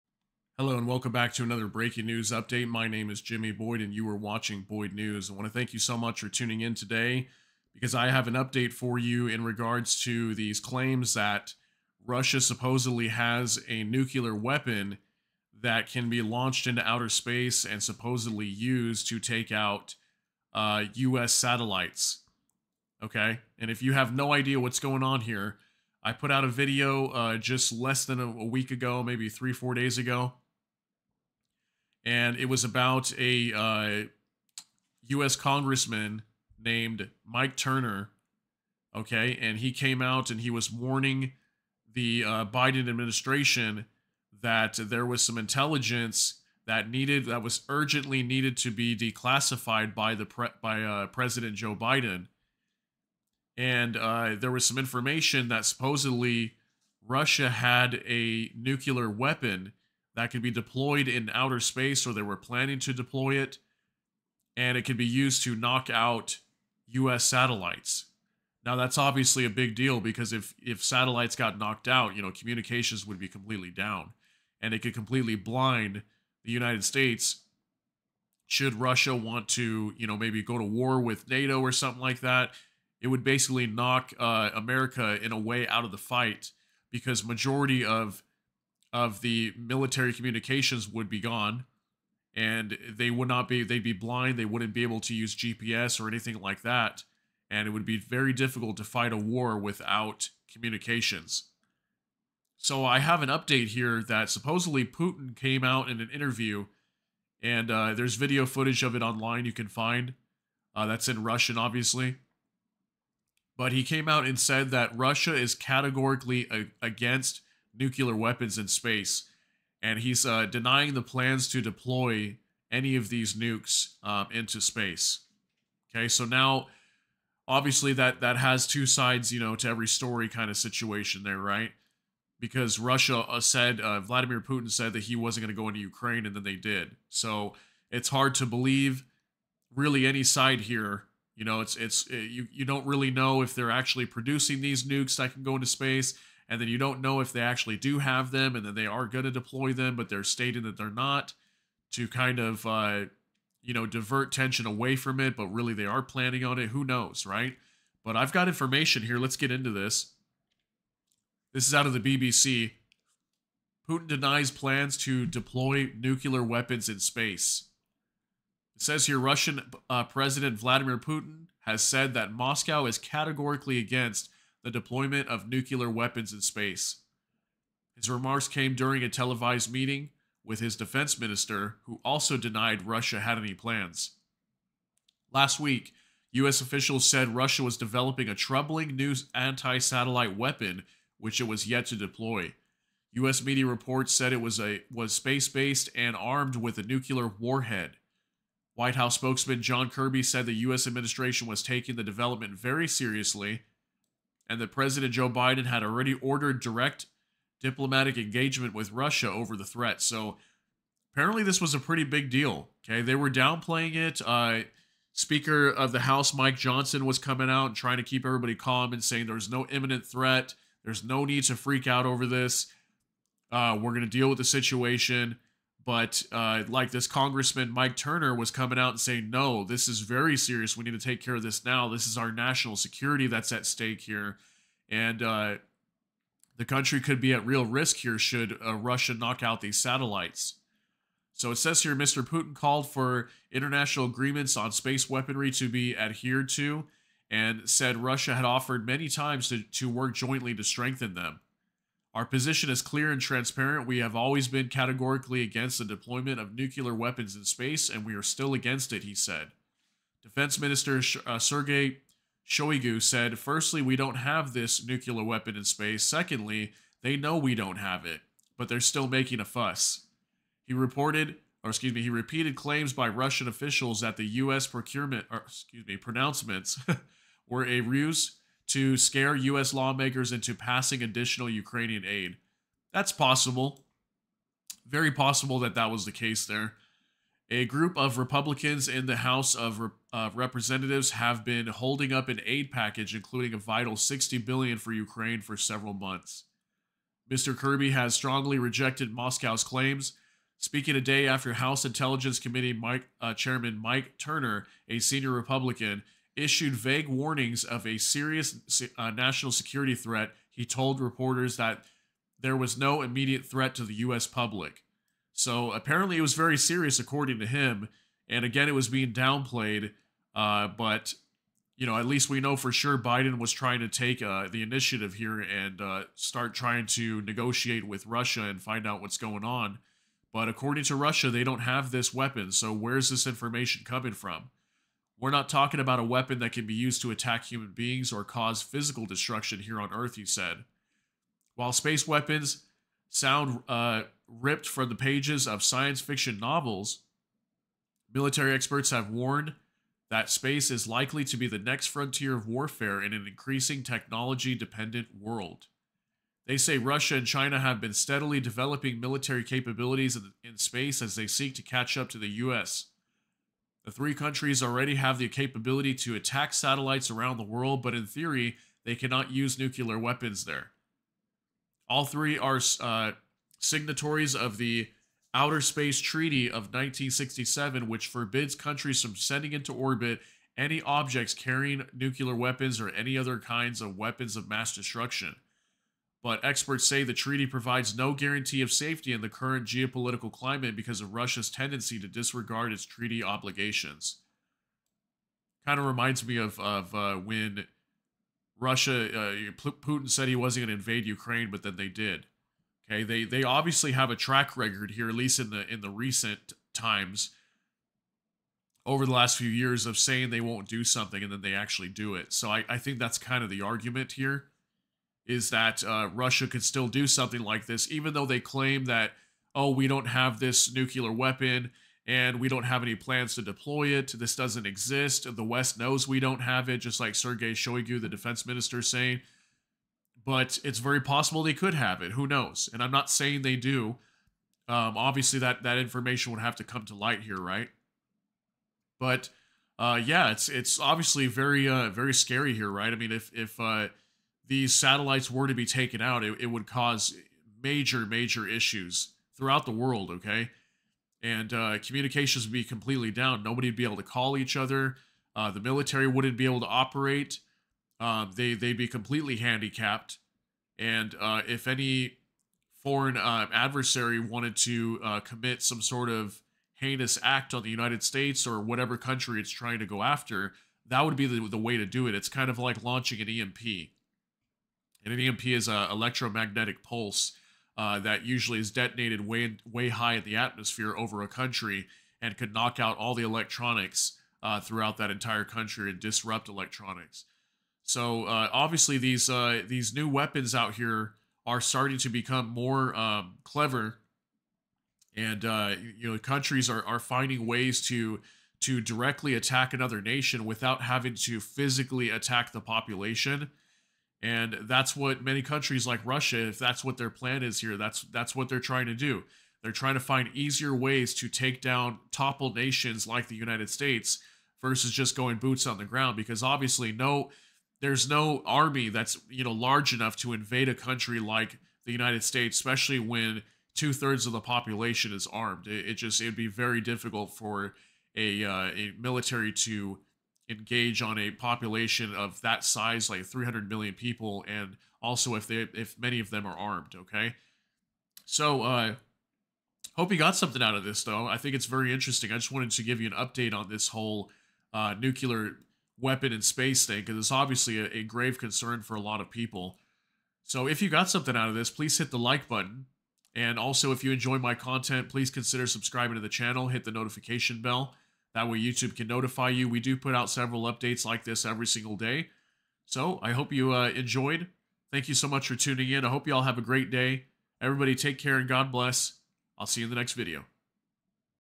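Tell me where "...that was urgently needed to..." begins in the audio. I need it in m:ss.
0:47.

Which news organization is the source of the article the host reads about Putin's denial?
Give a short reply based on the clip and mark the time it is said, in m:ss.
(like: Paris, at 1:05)
BBC, at 2:42.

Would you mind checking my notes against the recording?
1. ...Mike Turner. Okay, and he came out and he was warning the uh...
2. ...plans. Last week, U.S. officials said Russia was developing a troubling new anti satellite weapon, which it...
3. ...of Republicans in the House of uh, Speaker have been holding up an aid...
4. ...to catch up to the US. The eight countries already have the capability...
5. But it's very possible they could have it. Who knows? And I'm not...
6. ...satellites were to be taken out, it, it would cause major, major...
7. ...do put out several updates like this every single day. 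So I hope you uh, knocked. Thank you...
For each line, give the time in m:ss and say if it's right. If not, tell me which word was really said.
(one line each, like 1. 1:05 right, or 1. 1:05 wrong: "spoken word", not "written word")
1. 0:37 right
2. 3:03 right
3. 4:47 wrong: "Representatives", not "Speaker"
4. 6:01 wrong: "three", not "eight"
5. 7:10 right
6. 7:24 right
7. 9:19 wrong: "enjoyed", not "knocked".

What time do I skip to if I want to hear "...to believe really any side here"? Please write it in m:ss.
2:18.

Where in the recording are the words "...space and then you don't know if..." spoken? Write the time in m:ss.
2:25.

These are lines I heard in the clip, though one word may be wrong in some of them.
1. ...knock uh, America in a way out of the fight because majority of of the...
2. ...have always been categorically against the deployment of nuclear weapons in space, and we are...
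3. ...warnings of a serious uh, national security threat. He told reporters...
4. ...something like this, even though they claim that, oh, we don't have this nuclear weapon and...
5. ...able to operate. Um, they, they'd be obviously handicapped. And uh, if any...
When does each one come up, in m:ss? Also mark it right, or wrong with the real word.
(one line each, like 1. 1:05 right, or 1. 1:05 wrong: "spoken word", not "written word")
1. 1:23 right
2. 4:13 right
3. 5:07 right
4. 6:57 right
5. 7:36 wrong: "completely", not "obviously".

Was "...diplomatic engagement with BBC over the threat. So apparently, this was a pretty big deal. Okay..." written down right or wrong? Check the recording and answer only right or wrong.
wrong.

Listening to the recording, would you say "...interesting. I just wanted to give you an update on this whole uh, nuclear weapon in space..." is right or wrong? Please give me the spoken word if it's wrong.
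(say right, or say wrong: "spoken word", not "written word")
right.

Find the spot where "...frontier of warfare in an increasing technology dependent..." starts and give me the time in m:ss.
5:51.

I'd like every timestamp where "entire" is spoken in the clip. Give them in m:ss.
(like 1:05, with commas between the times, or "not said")
8:05.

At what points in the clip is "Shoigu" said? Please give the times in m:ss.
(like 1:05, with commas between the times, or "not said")
4:22, 7:07.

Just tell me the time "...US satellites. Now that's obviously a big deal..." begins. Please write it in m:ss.
1:06.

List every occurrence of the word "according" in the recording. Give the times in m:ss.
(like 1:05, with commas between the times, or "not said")
5:16, 5:30.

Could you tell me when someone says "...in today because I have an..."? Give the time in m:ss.
0:06.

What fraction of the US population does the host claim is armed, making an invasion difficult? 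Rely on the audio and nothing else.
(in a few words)
two-thirds.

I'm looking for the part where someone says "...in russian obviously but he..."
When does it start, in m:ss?
1:51.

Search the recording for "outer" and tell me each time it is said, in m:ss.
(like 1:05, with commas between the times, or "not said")
0:16, 1:01, 6:15.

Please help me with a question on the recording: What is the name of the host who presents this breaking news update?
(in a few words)
Jimmy Boyd.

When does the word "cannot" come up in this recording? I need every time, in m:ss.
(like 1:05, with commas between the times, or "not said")
6:08.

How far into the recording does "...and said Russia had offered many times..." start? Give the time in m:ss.
4:07.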